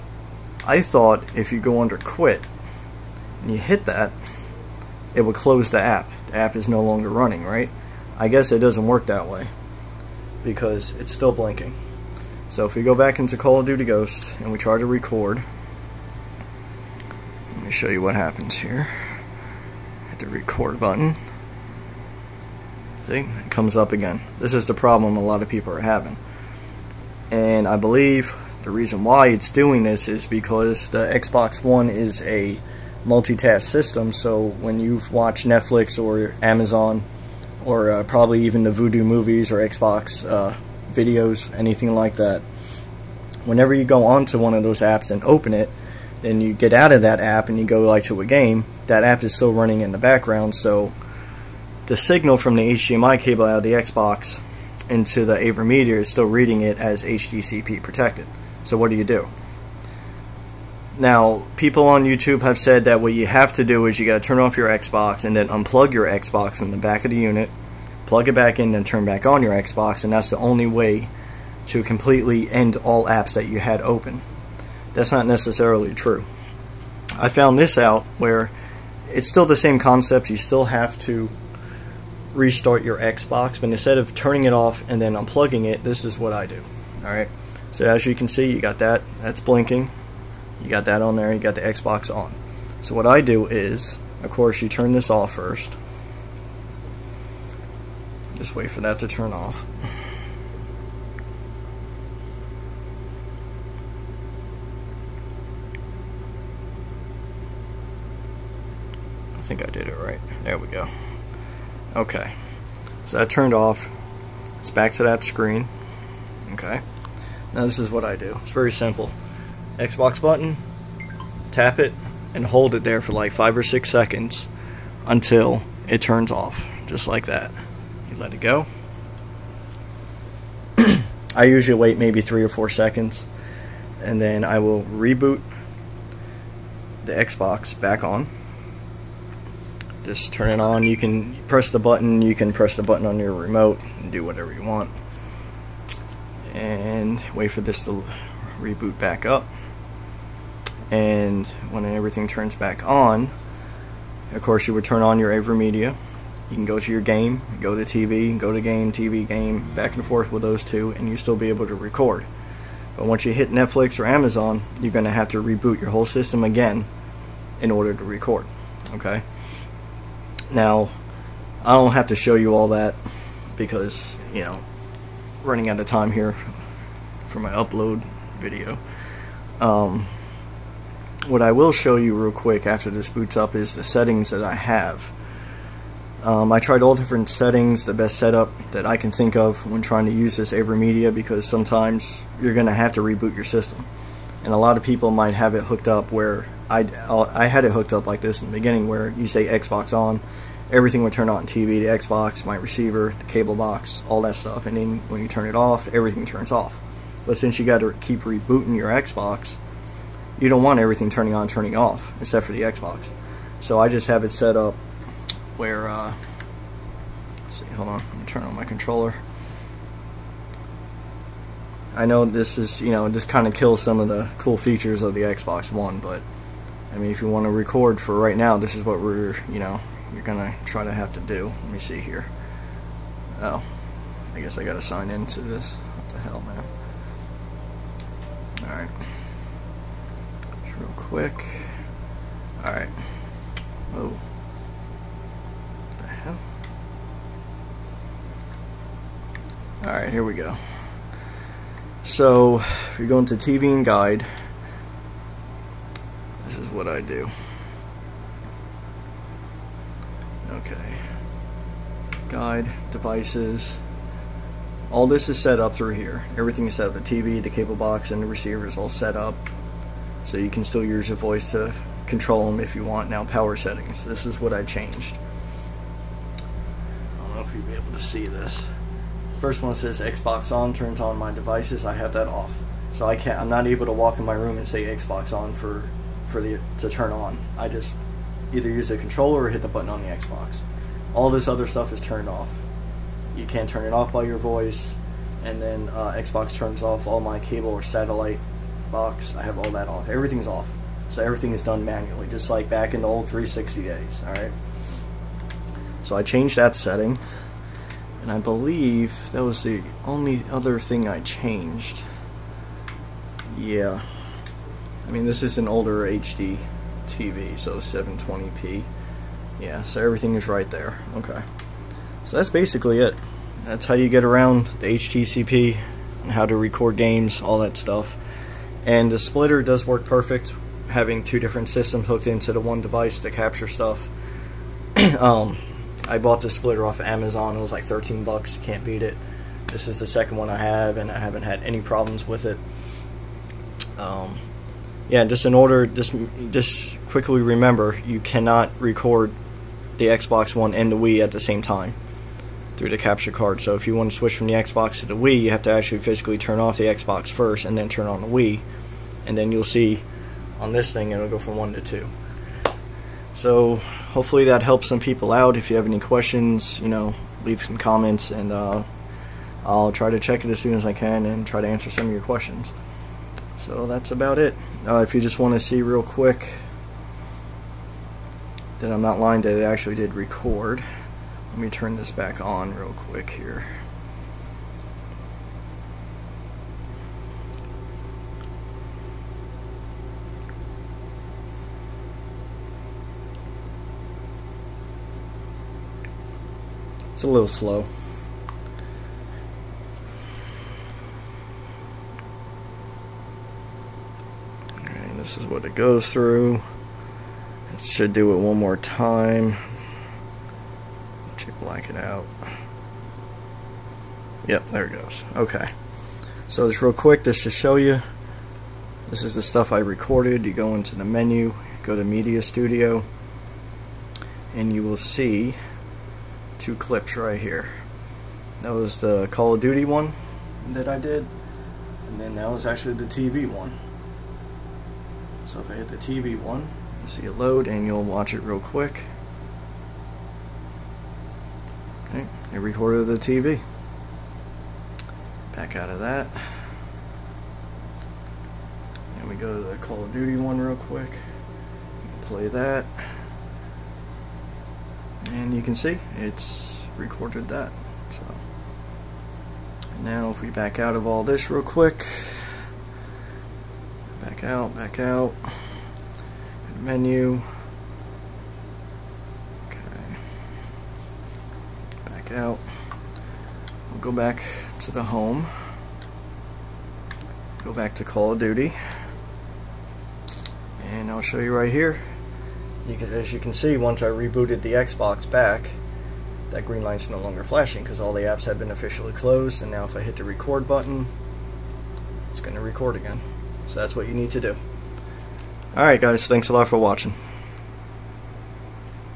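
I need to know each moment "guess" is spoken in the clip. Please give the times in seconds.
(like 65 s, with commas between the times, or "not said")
8 s, 234 s.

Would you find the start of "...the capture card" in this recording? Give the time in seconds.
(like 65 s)
352 s.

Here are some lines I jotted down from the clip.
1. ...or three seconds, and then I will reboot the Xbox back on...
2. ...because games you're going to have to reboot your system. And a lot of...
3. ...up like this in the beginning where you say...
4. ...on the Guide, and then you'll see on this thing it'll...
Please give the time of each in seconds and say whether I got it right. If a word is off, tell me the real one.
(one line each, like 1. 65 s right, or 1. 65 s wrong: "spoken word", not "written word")
1. 132 s wrong: "four", not "three"
2. 191 s wrong: "sometimes", not "games"
3. 197 s right
4. 358 s wrong: "Wii", not "Guide".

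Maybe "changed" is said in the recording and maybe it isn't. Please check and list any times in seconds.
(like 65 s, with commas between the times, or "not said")
274 s, 306 s, 311 s.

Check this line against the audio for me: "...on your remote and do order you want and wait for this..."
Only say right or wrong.
wrong.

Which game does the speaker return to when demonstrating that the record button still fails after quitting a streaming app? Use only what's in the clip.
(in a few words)
Call of Duty Ghost.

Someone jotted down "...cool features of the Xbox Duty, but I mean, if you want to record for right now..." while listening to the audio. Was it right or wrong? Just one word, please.
wrong.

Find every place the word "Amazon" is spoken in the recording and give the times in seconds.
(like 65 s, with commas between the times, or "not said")
36 s, 164 s, 337 s.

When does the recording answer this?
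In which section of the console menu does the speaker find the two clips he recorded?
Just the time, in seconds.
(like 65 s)
422 s.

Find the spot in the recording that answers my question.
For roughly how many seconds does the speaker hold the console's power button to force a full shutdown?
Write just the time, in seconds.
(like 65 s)
123 s.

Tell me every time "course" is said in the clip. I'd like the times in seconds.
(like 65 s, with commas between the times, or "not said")
94 s, 154 s.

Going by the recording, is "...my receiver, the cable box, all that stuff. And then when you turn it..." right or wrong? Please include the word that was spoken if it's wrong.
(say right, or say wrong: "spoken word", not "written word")
right.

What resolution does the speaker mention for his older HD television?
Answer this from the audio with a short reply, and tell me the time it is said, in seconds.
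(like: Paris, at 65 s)
720p, at 317 s.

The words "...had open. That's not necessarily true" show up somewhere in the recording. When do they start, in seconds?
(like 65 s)
73 s.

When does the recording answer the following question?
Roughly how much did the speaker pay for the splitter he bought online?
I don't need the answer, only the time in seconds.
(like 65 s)
337 s.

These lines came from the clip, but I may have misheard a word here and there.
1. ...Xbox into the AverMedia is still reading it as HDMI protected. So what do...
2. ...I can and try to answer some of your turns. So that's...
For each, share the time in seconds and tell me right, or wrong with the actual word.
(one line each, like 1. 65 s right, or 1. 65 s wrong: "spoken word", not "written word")
1. 53 s wrong: "HDCP", not "HDMI"
2. 370 s wrong: "questions", not "turns".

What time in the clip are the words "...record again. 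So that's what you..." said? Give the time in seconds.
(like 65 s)
492 s.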